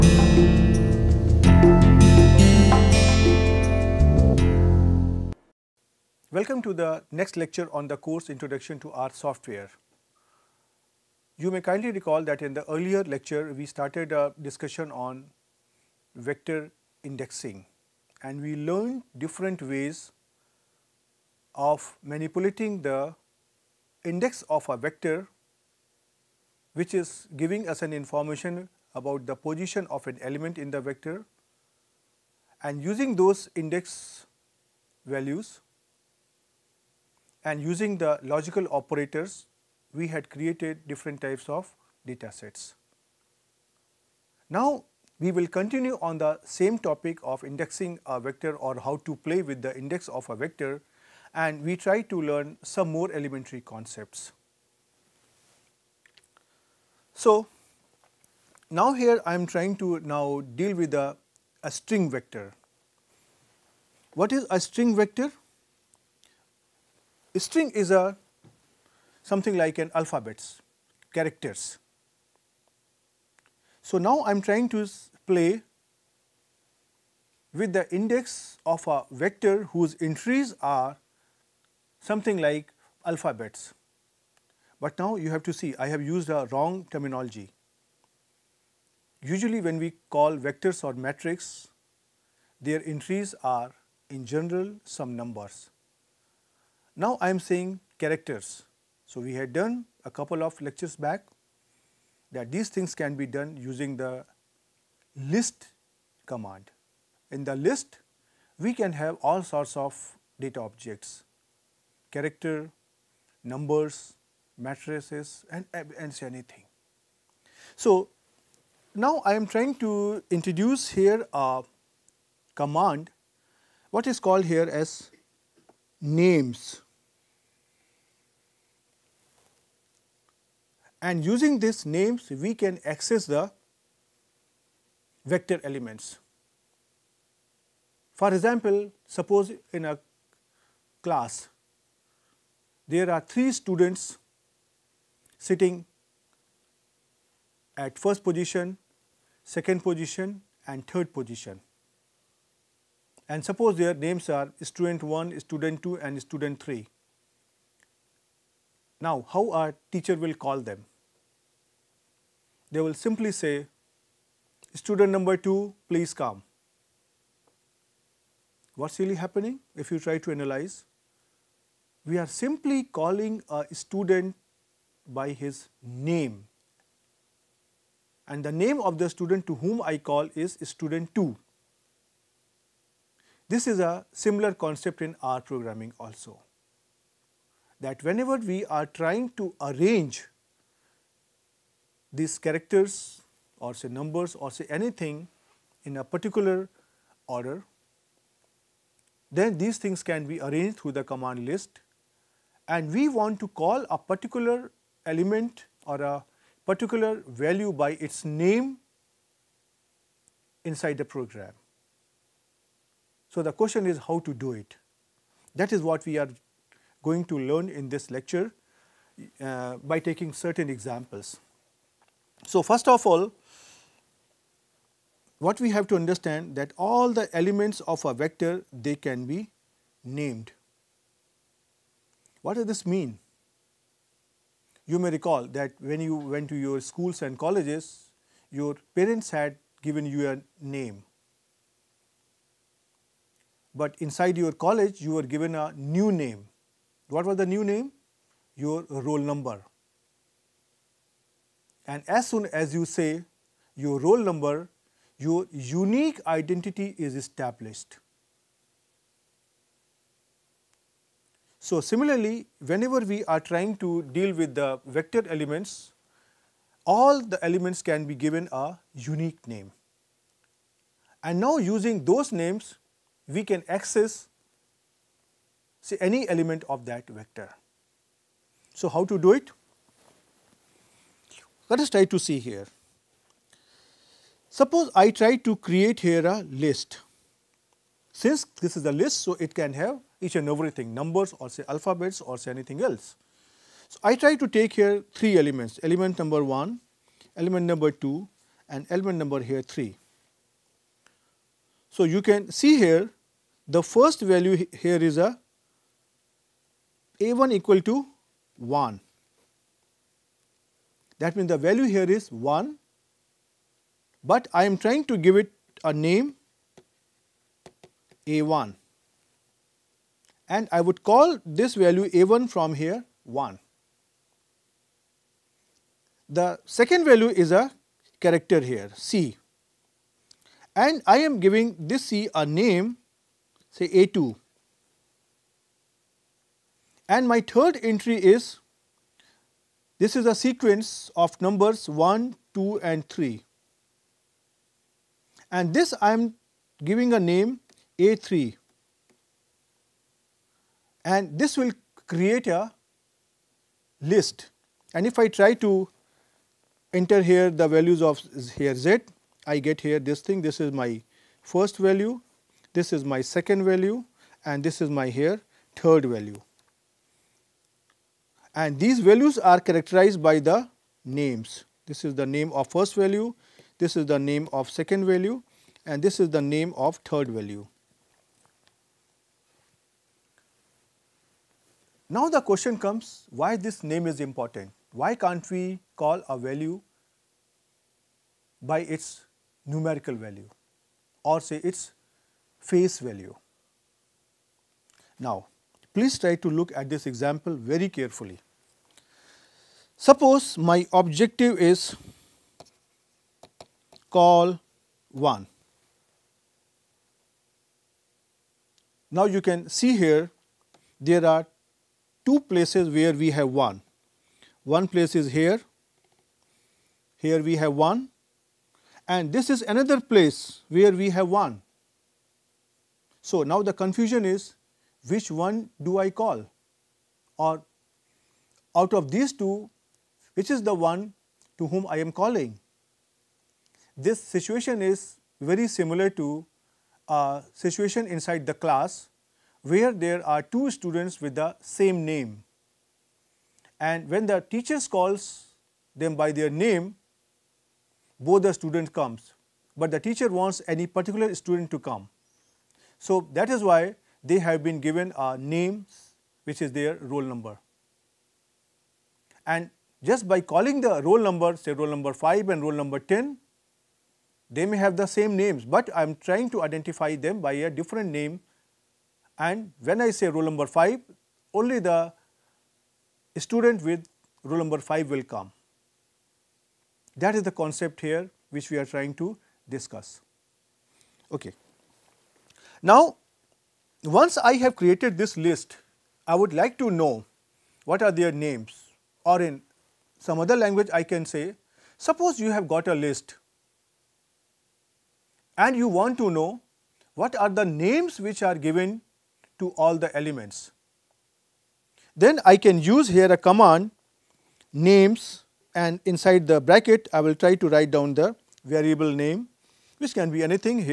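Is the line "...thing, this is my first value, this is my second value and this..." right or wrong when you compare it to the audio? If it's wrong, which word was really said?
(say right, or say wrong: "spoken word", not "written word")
right.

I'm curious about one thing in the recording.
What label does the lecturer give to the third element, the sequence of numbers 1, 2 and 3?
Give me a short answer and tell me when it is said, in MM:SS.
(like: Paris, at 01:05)
A3, at 05:47.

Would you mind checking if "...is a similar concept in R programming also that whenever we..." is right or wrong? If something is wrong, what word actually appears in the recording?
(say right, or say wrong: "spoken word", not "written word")
right.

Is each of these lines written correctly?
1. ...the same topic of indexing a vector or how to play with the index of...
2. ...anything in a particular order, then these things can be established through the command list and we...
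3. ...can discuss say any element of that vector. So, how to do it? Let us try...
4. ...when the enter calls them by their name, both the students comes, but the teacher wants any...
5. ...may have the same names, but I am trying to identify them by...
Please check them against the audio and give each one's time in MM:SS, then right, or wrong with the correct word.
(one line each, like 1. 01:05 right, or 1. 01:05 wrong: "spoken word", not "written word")
1. 00:46 right
2. 03:14 wrong: "arranged", not "established"
3. 04:33 wrong: "access", not "discuss"
4. 07:24 wrong: "teacher", not "enter"
5. 07:44 right.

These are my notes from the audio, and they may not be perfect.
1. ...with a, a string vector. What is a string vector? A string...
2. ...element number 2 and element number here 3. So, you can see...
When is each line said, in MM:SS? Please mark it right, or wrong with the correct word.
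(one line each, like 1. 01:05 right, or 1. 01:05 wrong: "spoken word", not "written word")
1. 01:00 right
2. 04:57 right.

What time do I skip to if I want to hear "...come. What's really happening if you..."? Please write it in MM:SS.
02:46.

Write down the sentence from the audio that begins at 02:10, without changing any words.
And using these names we can access the vector elements.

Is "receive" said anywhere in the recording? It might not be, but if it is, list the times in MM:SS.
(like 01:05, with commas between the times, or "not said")
not said.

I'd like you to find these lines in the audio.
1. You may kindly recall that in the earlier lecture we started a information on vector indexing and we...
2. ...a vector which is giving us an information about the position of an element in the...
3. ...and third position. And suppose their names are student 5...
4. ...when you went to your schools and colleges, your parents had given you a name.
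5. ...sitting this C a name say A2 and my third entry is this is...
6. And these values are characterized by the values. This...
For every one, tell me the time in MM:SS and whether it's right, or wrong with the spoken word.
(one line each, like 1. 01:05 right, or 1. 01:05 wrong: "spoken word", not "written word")
1. 00:11 wrong: "discussion", not "information"
2. 00:24 right
3. 02:30 wrong: "1", not "5"
4. 03:55 right
5. 05:31 wrong: "giving", not "sitting"
6. 06:08 wrong: "names", not "values".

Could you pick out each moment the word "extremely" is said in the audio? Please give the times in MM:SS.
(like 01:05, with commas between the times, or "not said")
not said.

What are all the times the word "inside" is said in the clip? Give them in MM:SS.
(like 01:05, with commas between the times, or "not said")
03:30, 04:04, 07:18, 08:26.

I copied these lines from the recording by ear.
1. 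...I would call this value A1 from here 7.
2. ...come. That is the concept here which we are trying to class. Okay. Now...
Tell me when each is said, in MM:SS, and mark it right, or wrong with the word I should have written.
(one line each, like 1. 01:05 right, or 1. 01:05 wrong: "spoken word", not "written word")
1. 05:20 wrong: "1", not "7"
2. 07:55 wrong: "discuss", not "class".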